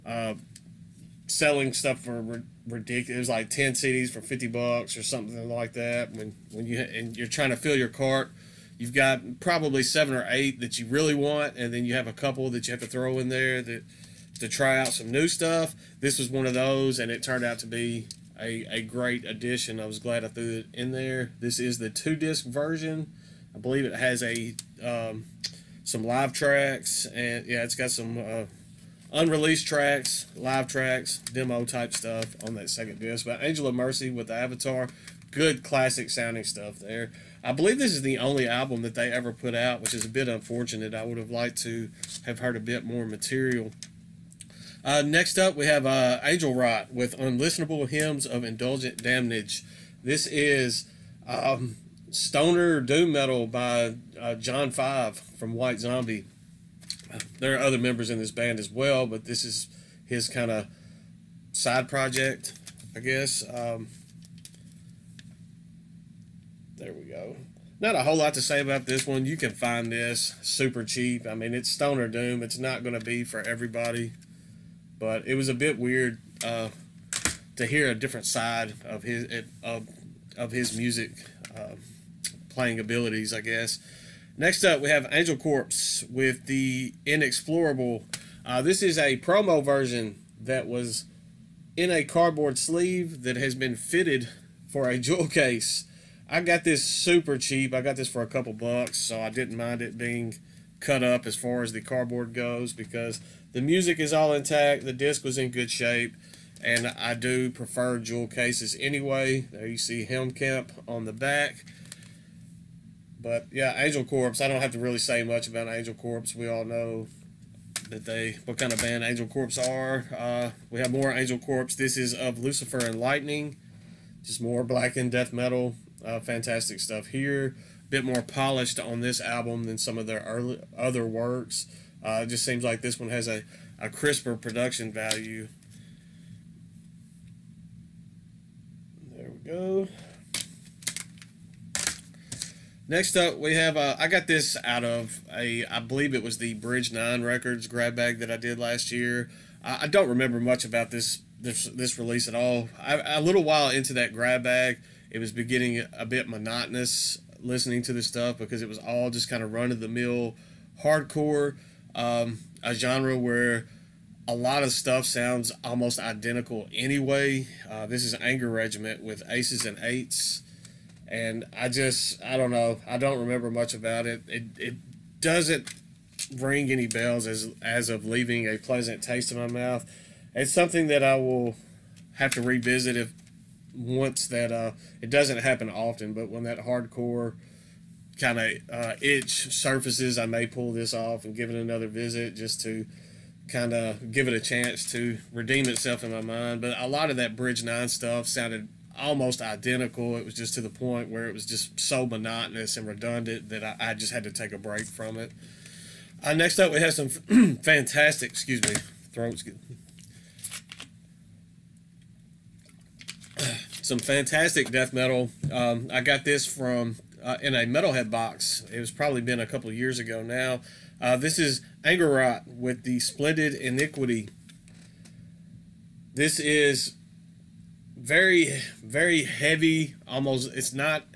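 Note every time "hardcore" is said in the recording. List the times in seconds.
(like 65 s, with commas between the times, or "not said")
160 s, 186 s.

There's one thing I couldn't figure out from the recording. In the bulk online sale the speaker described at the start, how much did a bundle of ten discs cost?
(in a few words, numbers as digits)
$50.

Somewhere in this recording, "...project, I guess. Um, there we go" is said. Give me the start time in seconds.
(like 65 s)
61 s.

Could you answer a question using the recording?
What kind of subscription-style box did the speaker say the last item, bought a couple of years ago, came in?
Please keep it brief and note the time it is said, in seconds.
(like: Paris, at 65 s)
metalhead box, at 217 s.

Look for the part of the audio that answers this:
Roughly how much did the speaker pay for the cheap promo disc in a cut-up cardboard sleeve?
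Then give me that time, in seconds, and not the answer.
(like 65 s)
98 s.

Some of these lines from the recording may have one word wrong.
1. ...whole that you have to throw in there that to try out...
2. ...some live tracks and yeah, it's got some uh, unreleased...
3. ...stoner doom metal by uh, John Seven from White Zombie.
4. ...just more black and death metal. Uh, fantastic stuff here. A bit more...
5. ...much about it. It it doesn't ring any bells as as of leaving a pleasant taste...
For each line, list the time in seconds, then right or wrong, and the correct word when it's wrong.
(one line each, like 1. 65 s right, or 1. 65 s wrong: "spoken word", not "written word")
1. 12 s wrong: "couple", not "whole"
2. 25 s right
3. 52 s wrong: "Five", not "Seven"
4. 124 s right
5. 173 s right.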